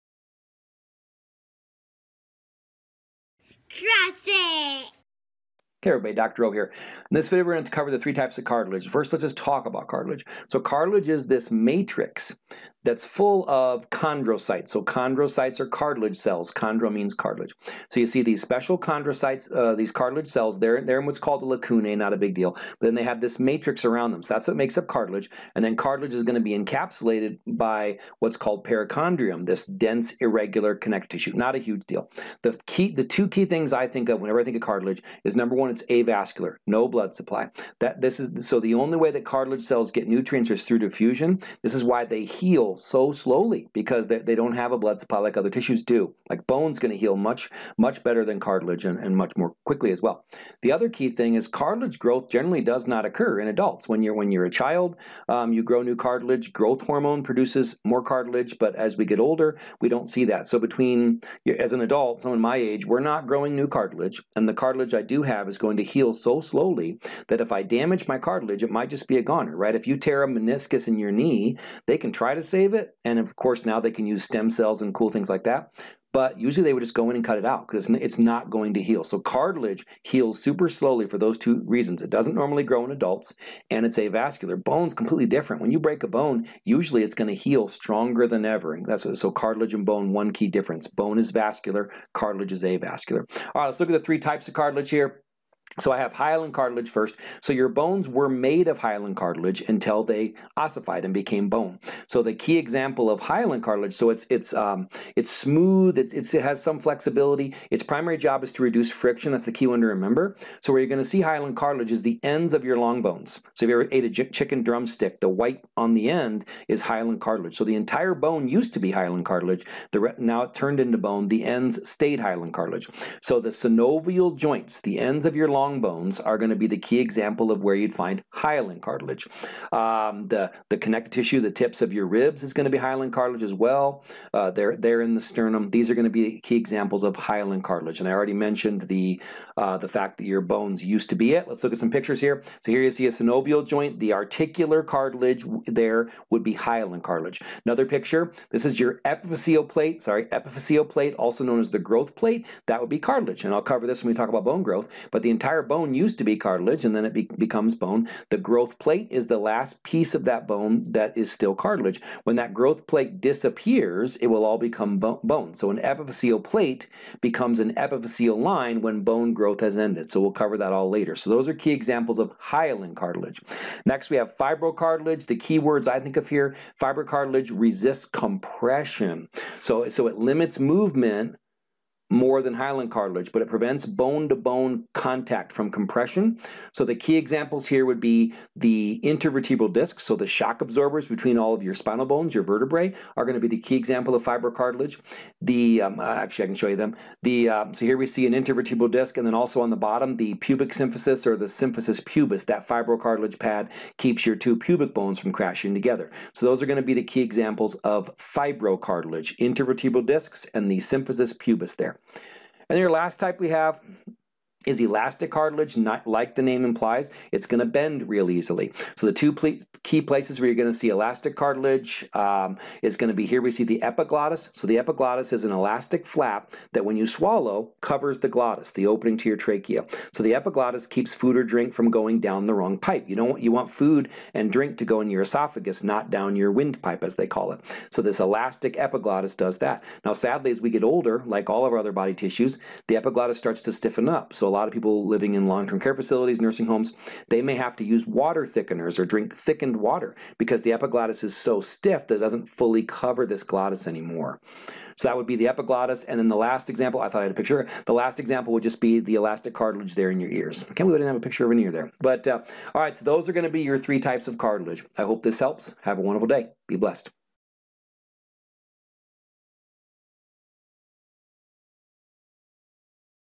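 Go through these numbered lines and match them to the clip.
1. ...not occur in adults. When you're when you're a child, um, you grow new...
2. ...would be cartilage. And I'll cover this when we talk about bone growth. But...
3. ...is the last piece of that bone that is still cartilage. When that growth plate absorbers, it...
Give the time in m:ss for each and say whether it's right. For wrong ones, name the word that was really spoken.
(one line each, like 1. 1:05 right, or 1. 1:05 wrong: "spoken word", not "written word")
1. 0:52 right
2. 2:32 right
3. 2:39 wrong: "disappears", not "absorbers".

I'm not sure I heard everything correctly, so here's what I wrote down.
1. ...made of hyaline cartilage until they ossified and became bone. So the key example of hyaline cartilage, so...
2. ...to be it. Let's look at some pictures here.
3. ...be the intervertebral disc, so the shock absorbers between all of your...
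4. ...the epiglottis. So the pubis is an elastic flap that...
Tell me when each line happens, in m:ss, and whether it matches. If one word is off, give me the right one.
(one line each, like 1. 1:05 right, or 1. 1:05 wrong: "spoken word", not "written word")
1. 1:38 right
2. 2:21 right
3. 3:08 right
4. 3:43 wrong: "epiglottis", not "pubis".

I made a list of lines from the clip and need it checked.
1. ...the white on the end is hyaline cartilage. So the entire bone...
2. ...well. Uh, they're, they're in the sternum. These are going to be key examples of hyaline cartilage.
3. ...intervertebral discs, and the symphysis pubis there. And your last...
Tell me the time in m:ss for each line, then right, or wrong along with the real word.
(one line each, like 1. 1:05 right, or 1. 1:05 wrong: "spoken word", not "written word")
1. 1:55 right
2. 2:13 right
3. 3:29 right.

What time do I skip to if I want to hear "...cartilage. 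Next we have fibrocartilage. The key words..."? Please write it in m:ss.
2:52.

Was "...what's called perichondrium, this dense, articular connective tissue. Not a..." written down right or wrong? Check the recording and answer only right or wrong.
wrong.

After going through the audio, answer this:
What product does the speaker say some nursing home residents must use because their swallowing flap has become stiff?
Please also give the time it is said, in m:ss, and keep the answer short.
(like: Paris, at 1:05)
water thickeners, at 4:08.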